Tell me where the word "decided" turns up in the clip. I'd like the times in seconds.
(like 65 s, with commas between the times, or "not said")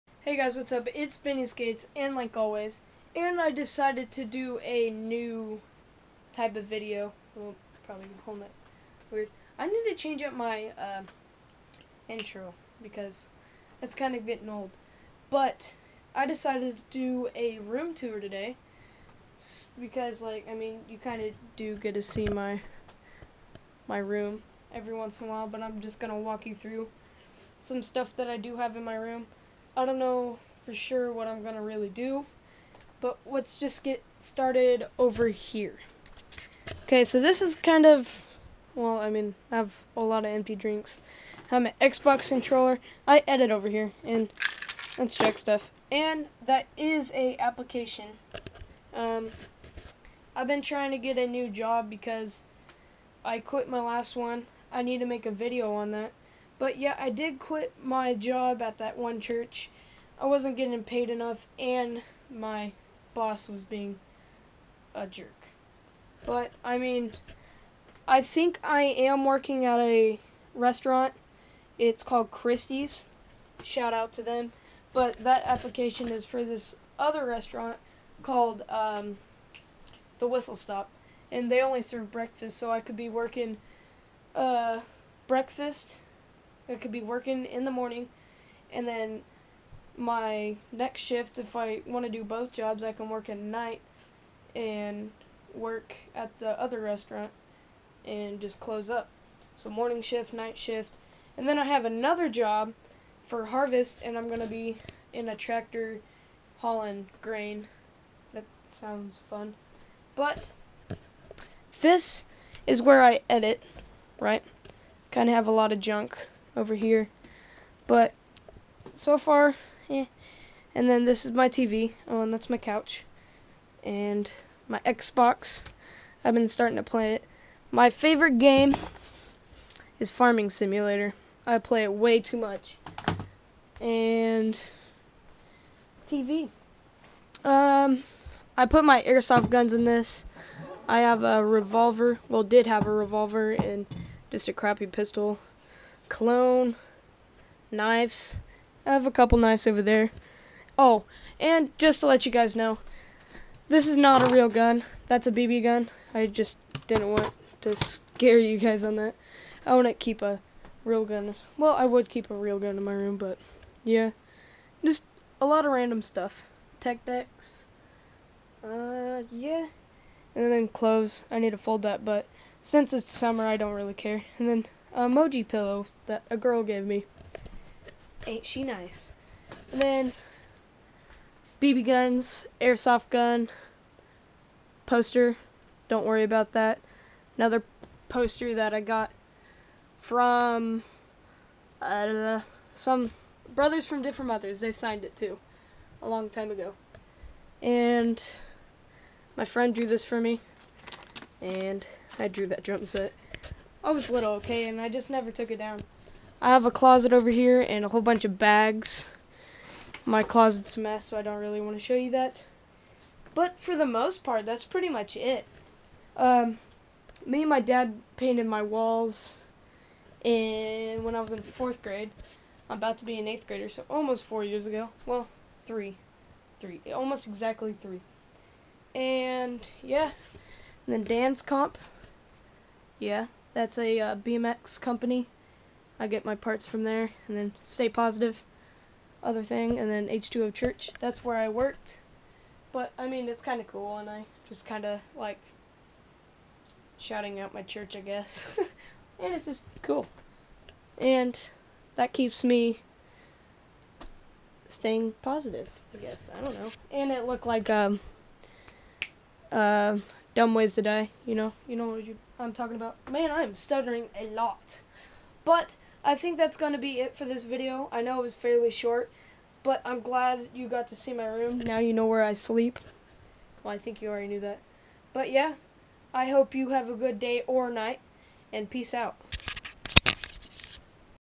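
3 s, 16 s.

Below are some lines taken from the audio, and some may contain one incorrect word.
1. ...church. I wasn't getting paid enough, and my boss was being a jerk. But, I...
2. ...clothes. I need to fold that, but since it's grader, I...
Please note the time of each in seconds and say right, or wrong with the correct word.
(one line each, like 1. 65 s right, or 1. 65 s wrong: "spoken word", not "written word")
1. 59 s right
2. 170 s wrong: "summer", not "grader".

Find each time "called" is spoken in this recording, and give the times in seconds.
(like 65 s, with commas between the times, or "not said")
72 s, 78 s.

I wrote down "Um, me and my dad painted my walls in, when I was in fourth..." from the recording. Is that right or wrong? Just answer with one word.
right.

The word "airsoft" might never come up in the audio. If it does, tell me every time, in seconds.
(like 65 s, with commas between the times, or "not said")
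139 s, 182 s.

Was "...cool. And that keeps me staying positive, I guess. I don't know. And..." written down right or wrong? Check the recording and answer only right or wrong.
right.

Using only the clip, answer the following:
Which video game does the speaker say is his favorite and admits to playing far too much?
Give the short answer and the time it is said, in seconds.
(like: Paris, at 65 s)
Farming Simulator, at 130 s.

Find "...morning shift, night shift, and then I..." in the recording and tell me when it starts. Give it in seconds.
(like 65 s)
99 s.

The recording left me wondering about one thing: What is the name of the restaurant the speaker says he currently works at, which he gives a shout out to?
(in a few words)
Christie's.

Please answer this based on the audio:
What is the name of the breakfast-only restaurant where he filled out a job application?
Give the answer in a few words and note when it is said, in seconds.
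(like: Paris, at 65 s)
The Whistle Stop, at 80 s.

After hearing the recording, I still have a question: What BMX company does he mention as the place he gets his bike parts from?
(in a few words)
Dan's Comp.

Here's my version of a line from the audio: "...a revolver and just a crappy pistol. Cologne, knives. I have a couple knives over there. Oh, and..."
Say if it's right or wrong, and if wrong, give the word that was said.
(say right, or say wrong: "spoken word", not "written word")
right.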